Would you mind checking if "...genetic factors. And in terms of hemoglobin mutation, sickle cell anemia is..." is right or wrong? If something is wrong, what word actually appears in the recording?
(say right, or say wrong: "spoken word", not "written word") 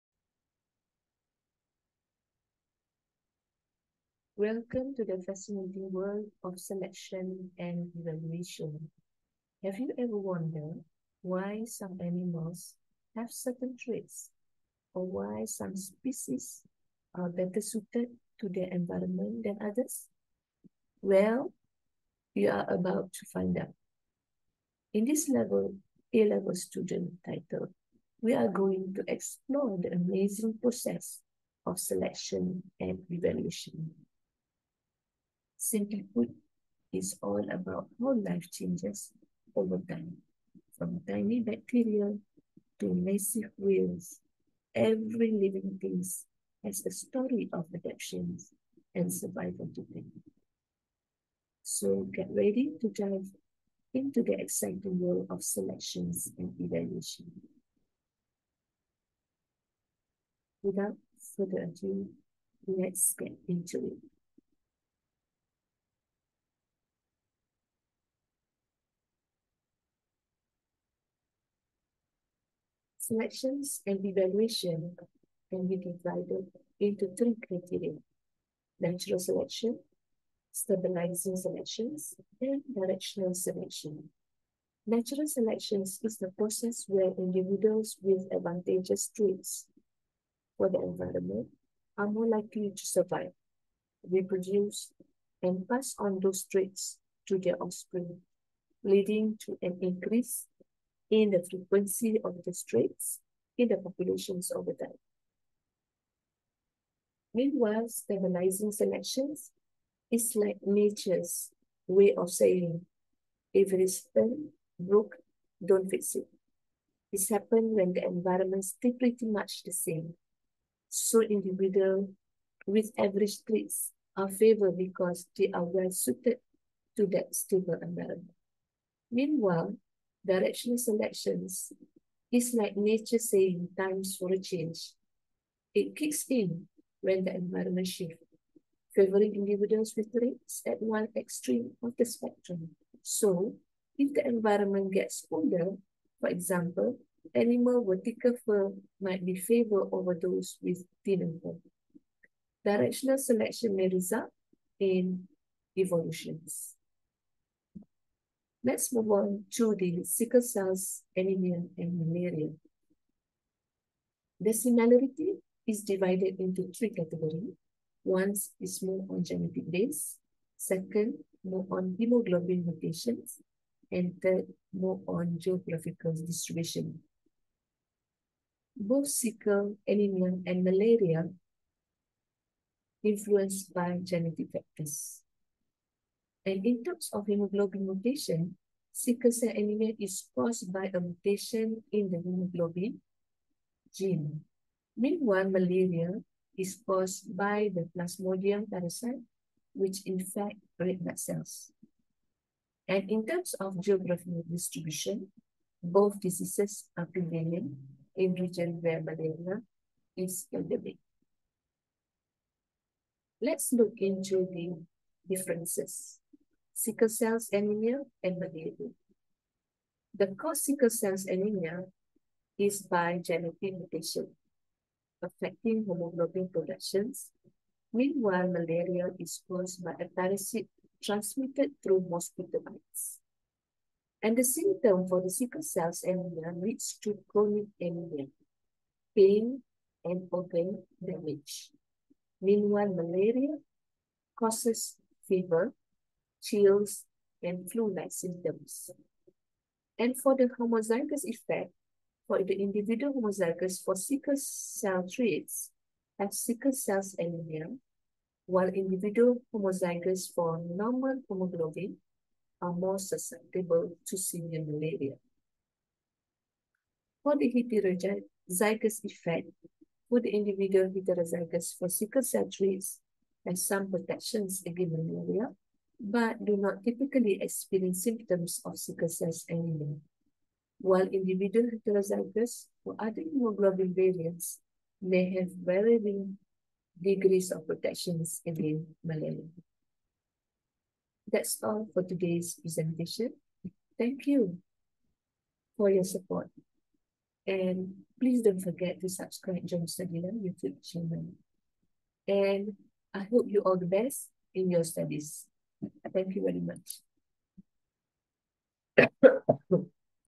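right.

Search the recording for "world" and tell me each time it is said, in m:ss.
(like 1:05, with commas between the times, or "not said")
0:05, 0:54.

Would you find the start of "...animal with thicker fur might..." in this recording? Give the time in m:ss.
2:27.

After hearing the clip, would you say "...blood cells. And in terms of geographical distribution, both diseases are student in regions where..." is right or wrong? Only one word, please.
wrong.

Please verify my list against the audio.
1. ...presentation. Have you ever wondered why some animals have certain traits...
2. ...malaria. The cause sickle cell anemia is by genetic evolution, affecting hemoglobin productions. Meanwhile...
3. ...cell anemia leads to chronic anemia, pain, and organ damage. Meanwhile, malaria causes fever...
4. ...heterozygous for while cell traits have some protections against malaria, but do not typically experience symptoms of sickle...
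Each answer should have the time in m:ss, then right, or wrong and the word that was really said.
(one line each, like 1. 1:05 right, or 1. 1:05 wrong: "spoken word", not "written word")
1. 0:08 wrong: "evolution", not "presentation"
2. 3:38 wrong: "mutation", not "evolution"
3. 3:55 right
4. 4:30 wrong: "sickle", not "while".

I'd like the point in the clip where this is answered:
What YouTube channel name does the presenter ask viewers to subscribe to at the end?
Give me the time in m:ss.
4:59.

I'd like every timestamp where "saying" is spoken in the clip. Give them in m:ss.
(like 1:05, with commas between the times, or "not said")
1:52, 2:13.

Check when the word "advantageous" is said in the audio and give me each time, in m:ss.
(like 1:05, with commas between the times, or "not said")
1:28.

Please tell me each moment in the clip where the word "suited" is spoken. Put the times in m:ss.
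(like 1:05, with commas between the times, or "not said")
0:17, 2:05.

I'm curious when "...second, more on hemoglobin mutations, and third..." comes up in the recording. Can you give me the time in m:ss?
2:50.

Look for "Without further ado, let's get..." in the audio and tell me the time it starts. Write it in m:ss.
1:00.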